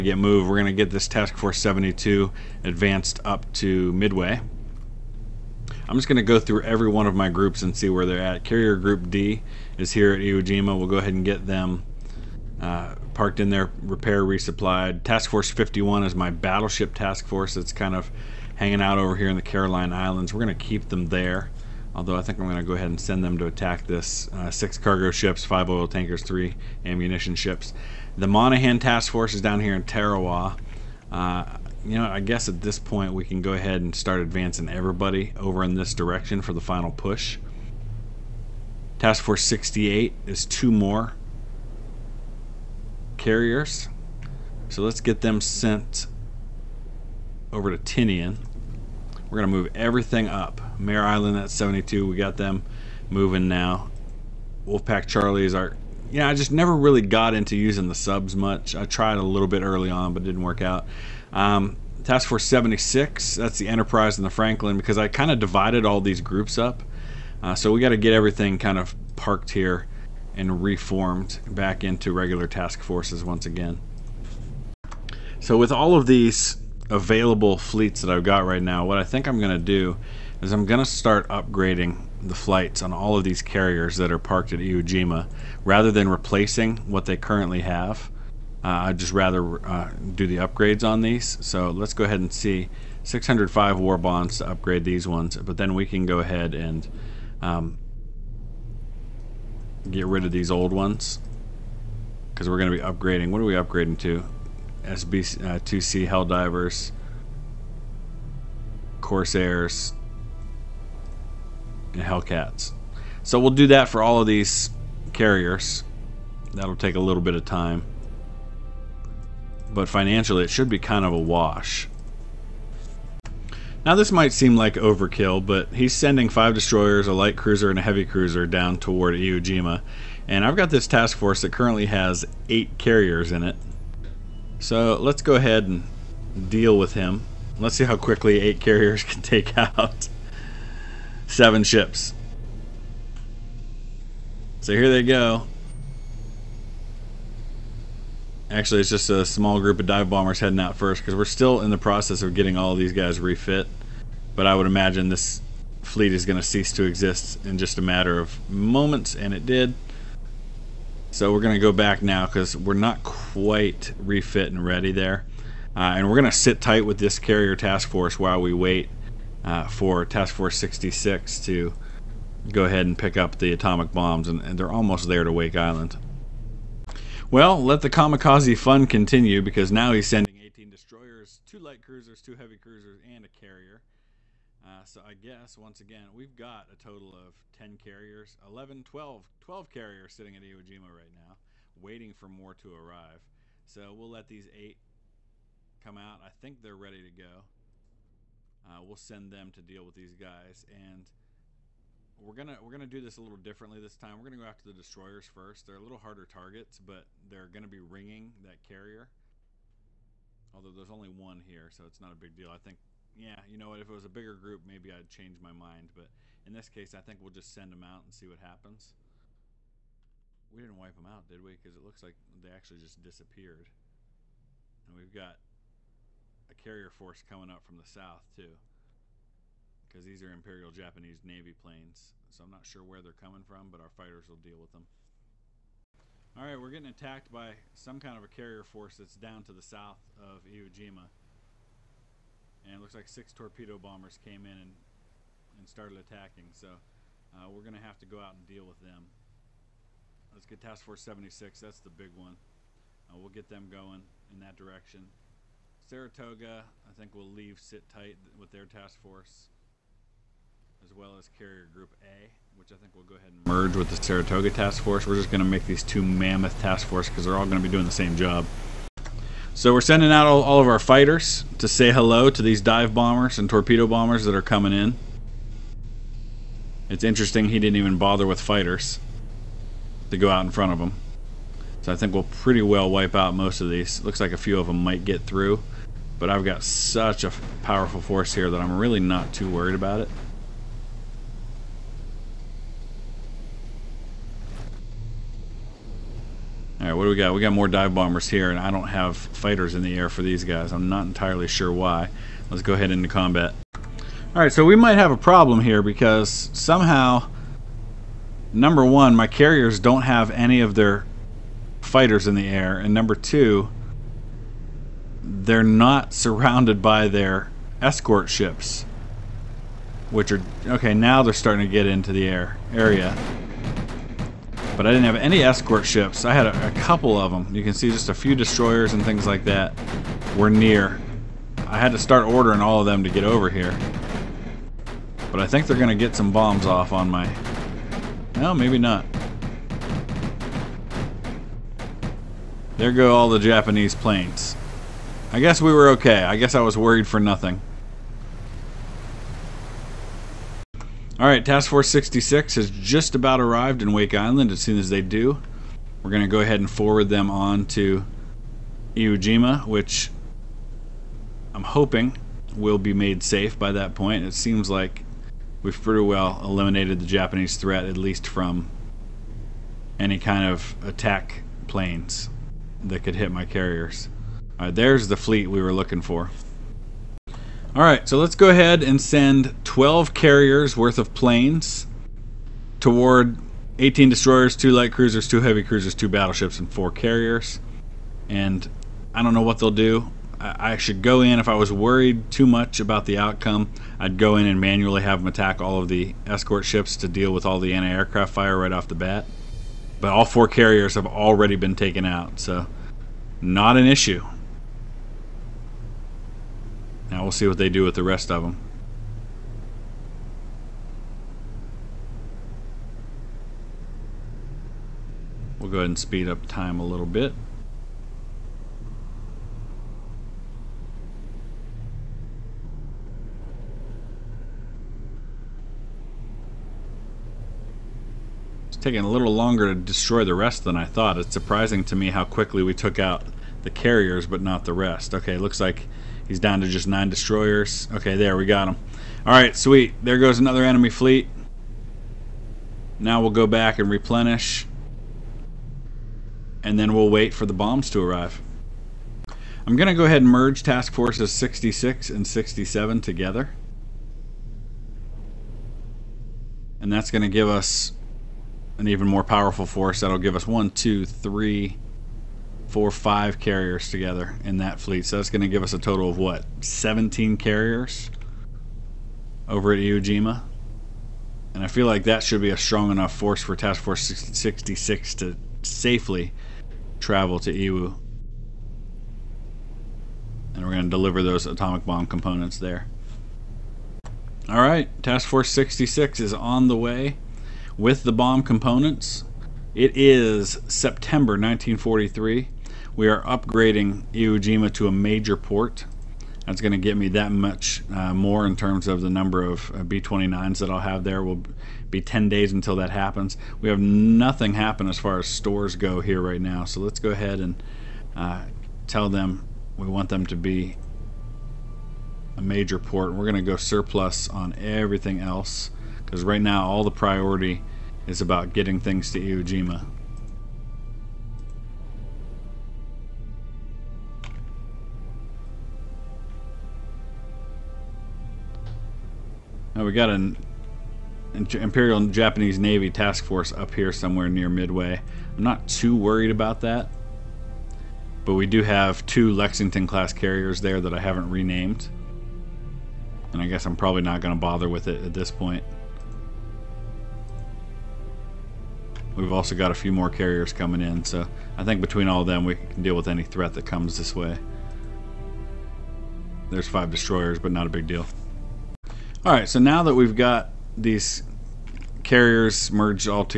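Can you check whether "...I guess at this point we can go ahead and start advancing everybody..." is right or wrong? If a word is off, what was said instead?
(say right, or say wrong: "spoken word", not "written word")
right.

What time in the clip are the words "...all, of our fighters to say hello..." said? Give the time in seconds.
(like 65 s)
270 s.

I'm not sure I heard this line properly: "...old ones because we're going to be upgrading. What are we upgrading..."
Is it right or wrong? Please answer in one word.
right.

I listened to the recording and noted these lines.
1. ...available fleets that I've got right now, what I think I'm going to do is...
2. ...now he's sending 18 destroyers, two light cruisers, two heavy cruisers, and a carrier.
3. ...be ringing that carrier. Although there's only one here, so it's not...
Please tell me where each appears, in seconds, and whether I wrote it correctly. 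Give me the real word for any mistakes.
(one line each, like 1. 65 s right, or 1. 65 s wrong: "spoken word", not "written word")
1. 76 s right
2. 179 s right
3. 207 s right.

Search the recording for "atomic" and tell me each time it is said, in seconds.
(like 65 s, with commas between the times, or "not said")
173 s, 481 s.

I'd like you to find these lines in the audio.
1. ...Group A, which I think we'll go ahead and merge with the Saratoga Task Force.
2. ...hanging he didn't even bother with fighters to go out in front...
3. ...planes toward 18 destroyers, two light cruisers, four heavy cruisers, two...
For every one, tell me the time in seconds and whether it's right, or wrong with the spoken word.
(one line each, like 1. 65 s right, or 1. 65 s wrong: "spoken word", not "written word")
1. 261 s right
2. 277 s wrong: "interesting", not "hanging"
3. 381 s wrong: "two", not "four".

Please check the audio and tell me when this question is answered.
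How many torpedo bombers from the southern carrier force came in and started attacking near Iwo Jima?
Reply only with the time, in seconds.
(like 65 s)
243 s.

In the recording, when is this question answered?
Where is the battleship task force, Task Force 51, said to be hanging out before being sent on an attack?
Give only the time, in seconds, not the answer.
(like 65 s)
19 s.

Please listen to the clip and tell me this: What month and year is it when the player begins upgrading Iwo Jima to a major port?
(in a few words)
September 1943.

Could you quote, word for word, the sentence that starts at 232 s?
So I'm not sure where they're coming from, but our fighters will deal with them.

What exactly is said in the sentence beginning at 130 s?
And I've got this task force that currently has eight carriers in it.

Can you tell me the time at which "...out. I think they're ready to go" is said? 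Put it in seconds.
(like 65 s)
195 s.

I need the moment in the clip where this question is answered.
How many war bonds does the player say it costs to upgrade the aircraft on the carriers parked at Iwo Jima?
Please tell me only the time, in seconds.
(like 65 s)
93 s.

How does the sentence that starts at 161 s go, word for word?
So we're going to go back now because we're not quite refit and ready there.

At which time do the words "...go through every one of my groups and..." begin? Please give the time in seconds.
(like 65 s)
6 s.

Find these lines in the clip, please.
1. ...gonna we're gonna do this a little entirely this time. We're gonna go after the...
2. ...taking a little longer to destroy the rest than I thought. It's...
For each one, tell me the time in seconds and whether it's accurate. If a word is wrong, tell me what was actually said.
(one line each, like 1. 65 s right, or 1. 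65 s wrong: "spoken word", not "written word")
1. 202 s wrong: "differently", not "entirely"
2. 428 s right.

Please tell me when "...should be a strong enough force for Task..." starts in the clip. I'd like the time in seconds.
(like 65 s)
472 s.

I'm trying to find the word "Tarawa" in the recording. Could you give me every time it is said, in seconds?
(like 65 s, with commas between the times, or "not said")
29 s.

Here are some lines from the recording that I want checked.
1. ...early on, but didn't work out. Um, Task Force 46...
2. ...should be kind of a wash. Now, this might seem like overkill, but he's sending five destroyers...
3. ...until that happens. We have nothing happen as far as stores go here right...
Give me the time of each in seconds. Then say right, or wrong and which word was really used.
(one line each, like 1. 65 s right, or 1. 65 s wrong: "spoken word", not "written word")
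1. 59 s wrong: "76", not "46"
2. 120 s right
3. 502 s right.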